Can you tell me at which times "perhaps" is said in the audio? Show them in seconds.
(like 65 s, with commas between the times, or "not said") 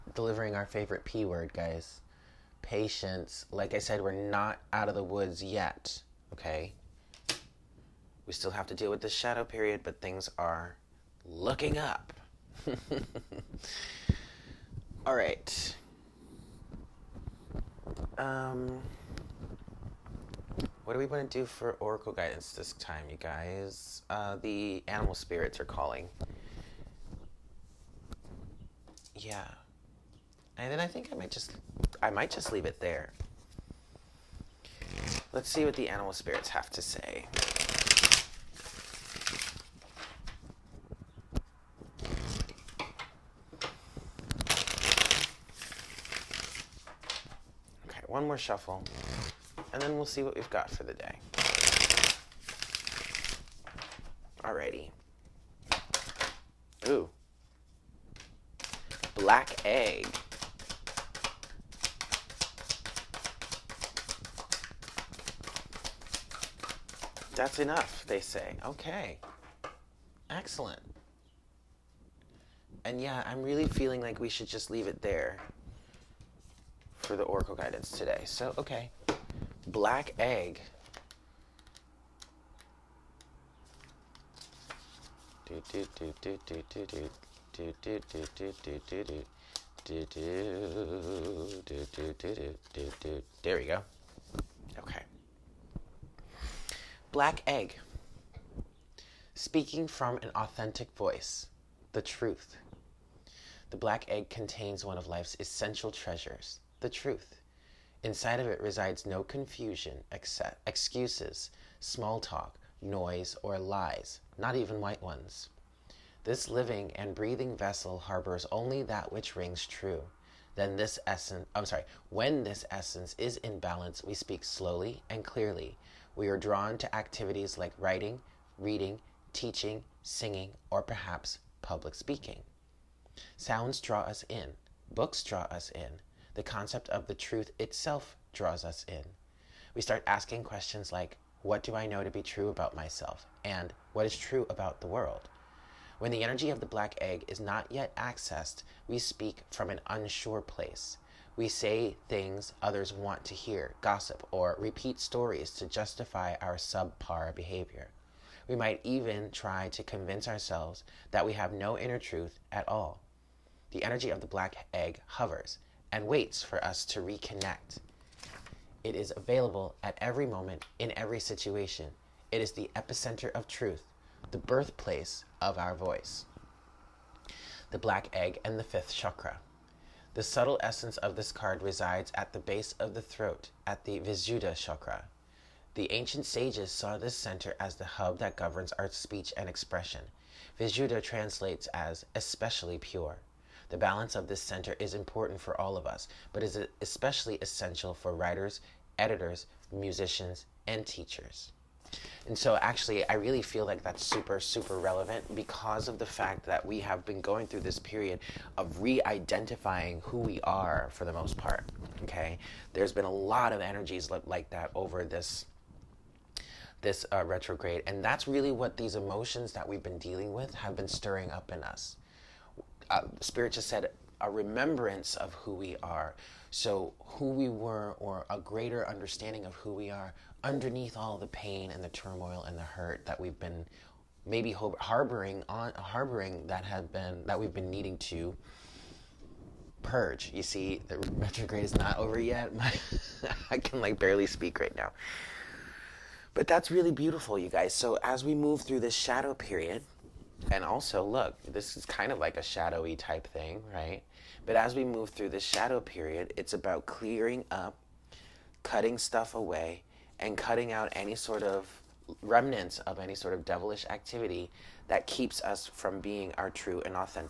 130 s.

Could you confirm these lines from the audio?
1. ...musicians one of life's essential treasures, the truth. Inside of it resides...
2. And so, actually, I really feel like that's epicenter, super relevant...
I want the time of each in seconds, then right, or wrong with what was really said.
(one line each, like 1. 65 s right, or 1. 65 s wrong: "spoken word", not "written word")
1. 104 s wrong: "contains", not "musicians"
2. 202 s wrong: "super", not "epicenter".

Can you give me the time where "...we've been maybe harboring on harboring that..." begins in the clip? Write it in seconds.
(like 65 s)
233 s.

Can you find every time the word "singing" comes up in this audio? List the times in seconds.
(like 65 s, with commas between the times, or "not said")
130 s.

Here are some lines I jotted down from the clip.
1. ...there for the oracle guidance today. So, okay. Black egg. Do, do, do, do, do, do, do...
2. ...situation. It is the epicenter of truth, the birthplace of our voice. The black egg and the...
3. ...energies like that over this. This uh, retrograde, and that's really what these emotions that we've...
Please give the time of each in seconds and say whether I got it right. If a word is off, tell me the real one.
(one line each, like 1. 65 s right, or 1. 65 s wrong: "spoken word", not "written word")
1. 75 s right
2. 171 s right
3. 213 s right.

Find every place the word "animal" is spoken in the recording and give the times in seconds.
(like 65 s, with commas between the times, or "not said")
24 s, 35 s.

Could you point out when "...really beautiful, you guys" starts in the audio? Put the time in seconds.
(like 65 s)
246 s.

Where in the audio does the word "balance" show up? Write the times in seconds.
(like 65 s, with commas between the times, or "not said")
123 s, 193 s.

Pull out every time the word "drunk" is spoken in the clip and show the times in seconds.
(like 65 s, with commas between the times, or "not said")
not said.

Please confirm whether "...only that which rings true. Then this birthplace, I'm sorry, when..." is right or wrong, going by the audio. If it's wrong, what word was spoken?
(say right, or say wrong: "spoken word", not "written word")
wrong: "essence", not "birthplace".